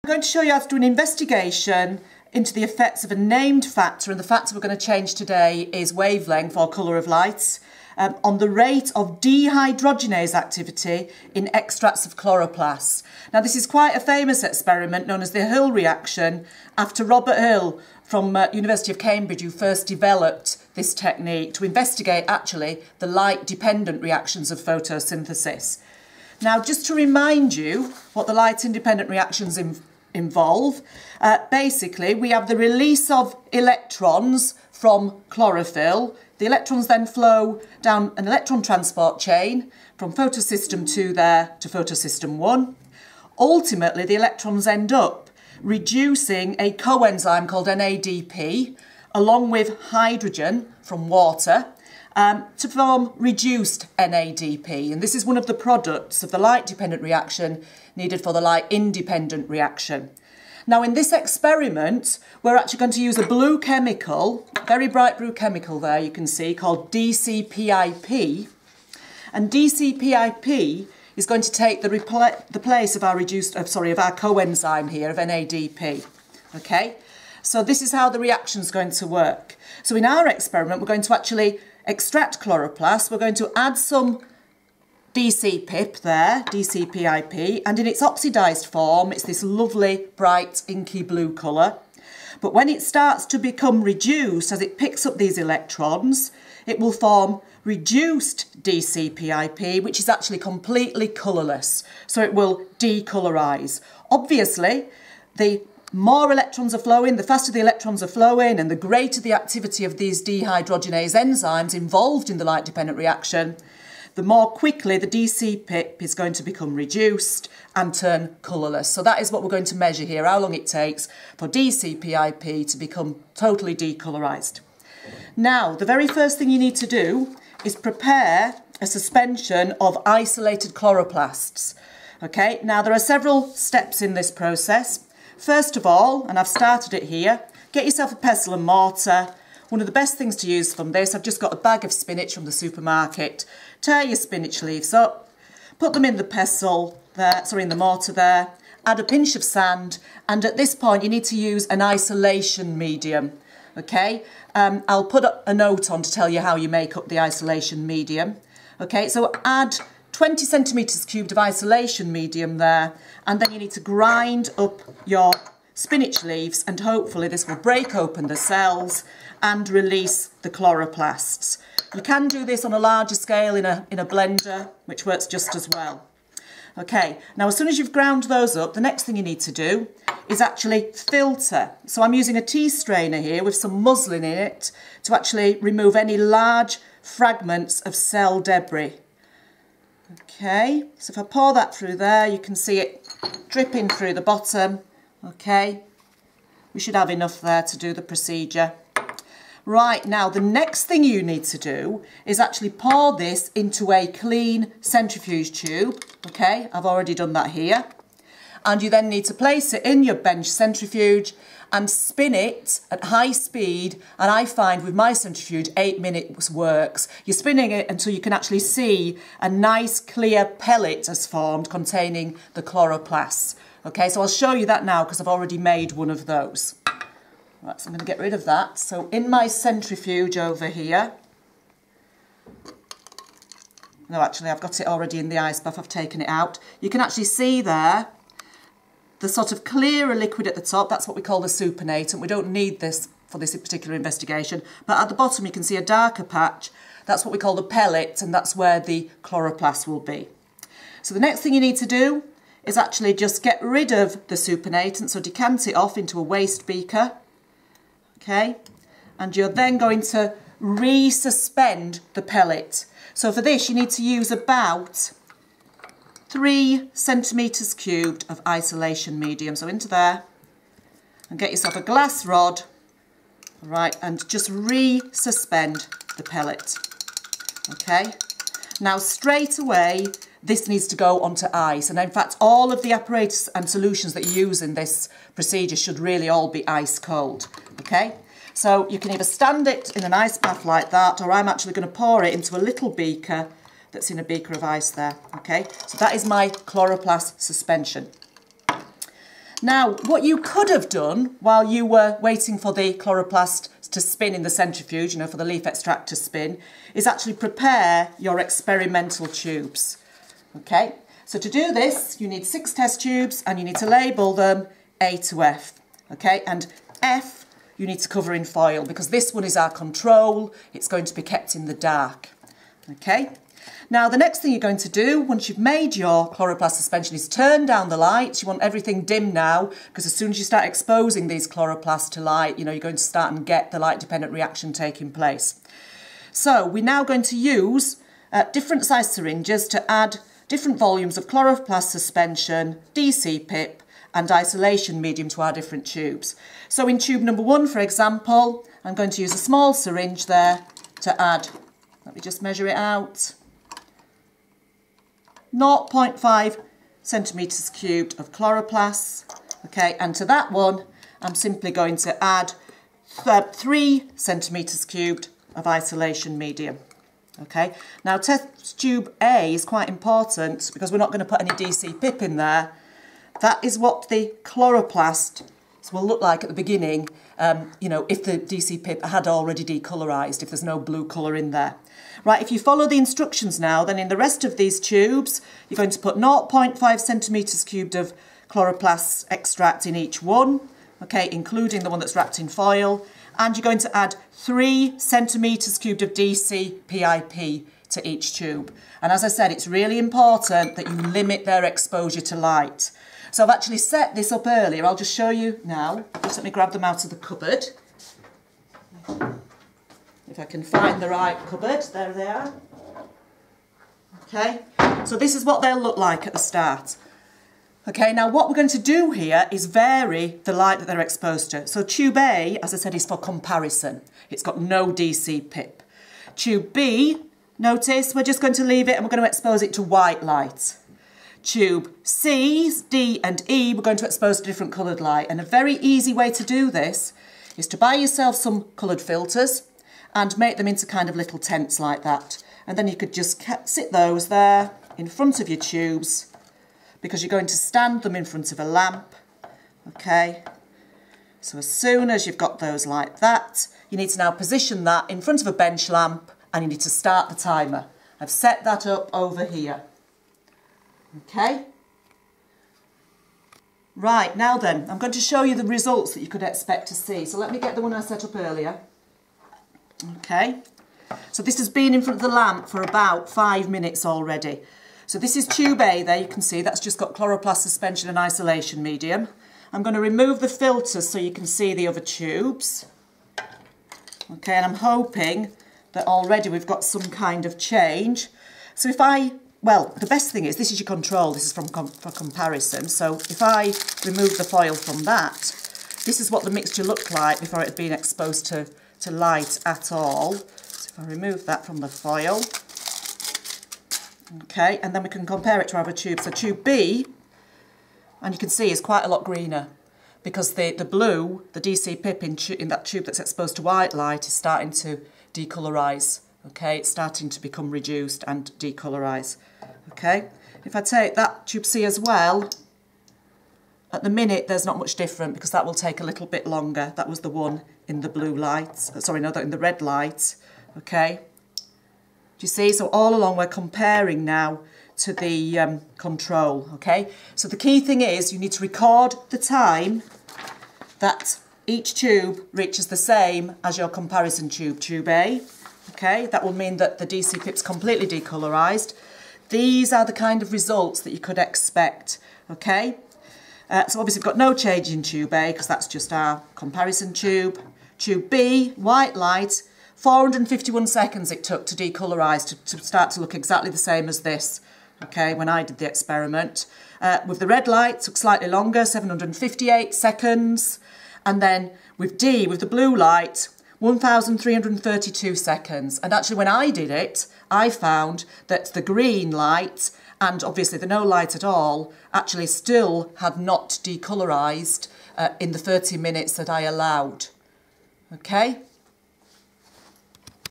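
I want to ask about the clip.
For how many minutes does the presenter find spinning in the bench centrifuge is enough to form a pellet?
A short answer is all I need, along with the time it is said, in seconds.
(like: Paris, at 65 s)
8, at 215 s.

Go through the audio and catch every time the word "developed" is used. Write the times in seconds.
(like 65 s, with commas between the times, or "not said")
19 s.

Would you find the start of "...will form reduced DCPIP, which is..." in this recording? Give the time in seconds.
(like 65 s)
96 s.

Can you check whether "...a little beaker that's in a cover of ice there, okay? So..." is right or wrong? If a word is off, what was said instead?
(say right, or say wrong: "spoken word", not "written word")
wrong: "beaker", not "cover".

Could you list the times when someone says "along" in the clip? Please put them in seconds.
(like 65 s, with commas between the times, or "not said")
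49 s, 533 s.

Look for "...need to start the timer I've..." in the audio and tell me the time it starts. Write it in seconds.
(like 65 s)
456 s.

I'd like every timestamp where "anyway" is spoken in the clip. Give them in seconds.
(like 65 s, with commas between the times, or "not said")
not said.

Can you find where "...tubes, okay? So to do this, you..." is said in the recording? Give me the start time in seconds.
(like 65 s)
309 s.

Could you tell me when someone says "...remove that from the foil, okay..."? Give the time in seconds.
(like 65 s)
501 s.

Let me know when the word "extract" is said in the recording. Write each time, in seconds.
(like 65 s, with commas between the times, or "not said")
11 s, 81 s, 305 s, 389 s.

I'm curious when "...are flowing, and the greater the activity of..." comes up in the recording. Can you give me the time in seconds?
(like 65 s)
108 s.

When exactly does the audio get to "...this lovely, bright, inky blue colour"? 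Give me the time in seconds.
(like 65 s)
89 s.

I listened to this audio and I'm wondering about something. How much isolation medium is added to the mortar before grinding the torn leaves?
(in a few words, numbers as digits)
20 cubic centimetres.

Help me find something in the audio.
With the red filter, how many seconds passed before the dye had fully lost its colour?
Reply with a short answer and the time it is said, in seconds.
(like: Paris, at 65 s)
758, at 568 s.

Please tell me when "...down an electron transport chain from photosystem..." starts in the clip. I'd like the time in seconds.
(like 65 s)
37 s.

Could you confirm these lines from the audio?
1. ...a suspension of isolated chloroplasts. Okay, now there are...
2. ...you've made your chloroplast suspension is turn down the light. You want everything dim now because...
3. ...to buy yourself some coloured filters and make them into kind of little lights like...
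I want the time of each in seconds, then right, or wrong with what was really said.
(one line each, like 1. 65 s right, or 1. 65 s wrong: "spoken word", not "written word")
1. 128 s right
2. 325 s right
3. 437 s wrong: "tents", not "lights".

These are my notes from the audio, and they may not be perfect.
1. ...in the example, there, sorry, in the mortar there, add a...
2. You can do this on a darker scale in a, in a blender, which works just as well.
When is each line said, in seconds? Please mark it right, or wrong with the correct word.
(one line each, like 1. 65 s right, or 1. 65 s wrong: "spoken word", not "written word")
1. 146 s wrong: "pestle", not "example"
2. 171 s wrong: "larger", not "darker".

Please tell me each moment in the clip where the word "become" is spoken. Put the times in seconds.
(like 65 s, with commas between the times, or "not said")
93 s, 116 s, 122 s, 517 s.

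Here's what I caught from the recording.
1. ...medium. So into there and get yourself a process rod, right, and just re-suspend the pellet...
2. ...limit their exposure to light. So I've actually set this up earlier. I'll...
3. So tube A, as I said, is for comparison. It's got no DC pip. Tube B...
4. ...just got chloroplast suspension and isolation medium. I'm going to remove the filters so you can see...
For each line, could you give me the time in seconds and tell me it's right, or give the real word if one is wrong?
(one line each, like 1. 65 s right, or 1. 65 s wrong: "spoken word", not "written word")
1. 269 s wrong: "glass", not "process"
2. 400 s right
3. 421 s right
4. 476 s right.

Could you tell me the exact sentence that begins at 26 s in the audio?
Now, just to remind you what the light-independent reactions in involve.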